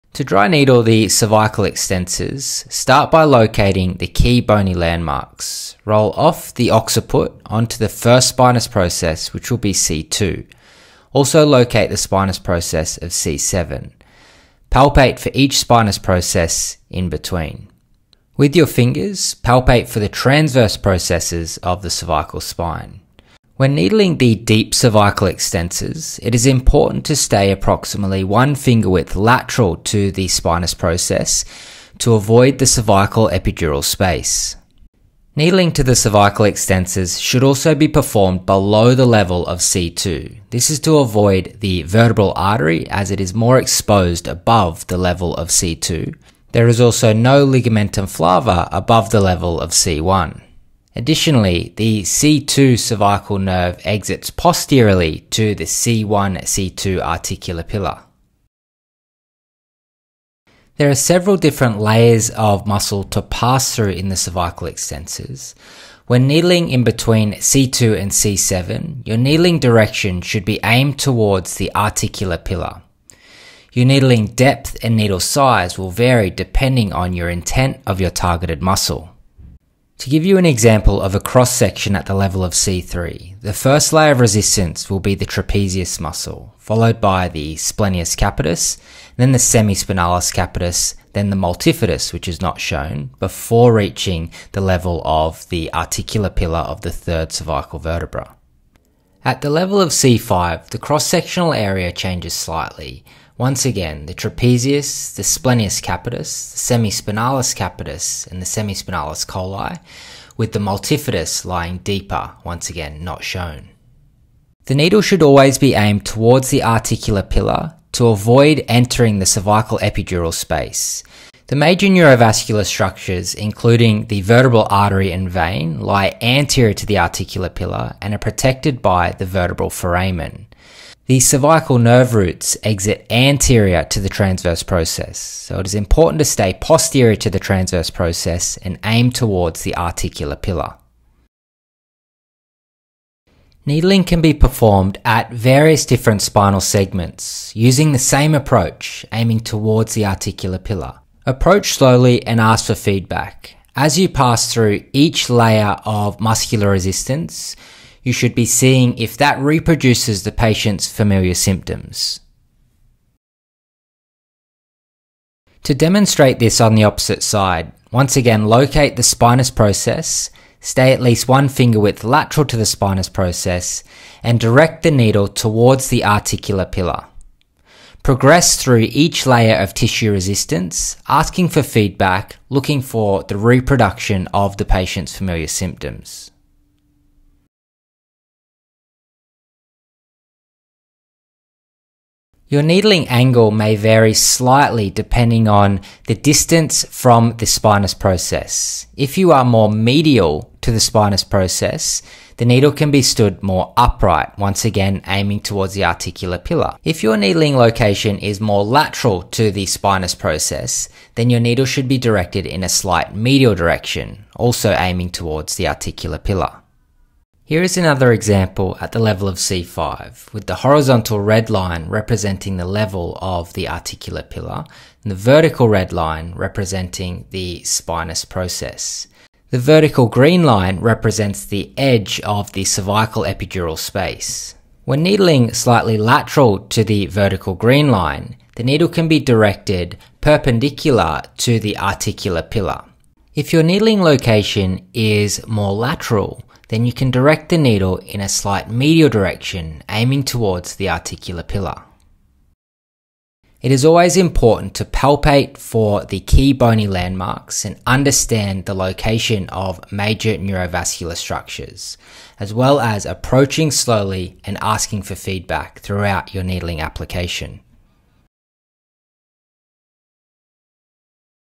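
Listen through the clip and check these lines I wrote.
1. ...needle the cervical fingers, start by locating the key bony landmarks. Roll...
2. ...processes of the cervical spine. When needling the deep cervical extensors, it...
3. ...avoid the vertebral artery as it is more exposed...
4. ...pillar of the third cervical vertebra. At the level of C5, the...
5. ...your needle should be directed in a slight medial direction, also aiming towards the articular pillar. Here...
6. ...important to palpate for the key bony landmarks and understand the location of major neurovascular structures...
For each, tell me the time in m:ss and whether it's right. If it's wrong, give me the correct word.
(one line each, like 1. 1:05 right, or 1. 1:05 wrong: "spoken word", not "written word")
1. 0:00 wrong: "extensors", not "fingers"
2. 0:20 right
3. 0:40 right
4. 1:36 right
5. 3:31 right
6. 4:14 right.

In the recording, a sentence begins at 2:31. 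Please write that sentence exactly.
Approach slowly and ask for feedback.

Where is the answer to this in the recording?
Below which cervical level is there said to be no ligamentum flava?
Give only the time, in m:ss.
0:47.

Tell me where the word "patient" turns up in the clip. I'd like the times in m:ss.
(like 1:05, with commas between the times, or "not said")
2:40, 3:04.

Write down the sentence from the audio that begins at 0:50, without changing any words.
Additionally, the C2 cervical nerve exits posteriorly to the C1 C2 articular pillar.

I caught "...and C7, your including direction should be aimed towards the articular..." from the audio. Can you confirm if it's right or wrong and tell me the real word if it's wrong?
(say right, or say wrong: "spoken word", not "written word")
wrong: "needling", not "including".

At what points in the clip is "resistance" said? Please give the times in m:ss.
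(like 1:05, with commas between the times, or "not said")
1:24, 2:36, 3:00.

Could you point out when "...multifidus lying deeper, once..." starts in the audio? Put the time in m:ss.
1:50.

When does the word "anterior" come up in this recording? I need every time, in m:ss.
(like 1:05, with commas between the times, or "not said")
2:06, 2:13.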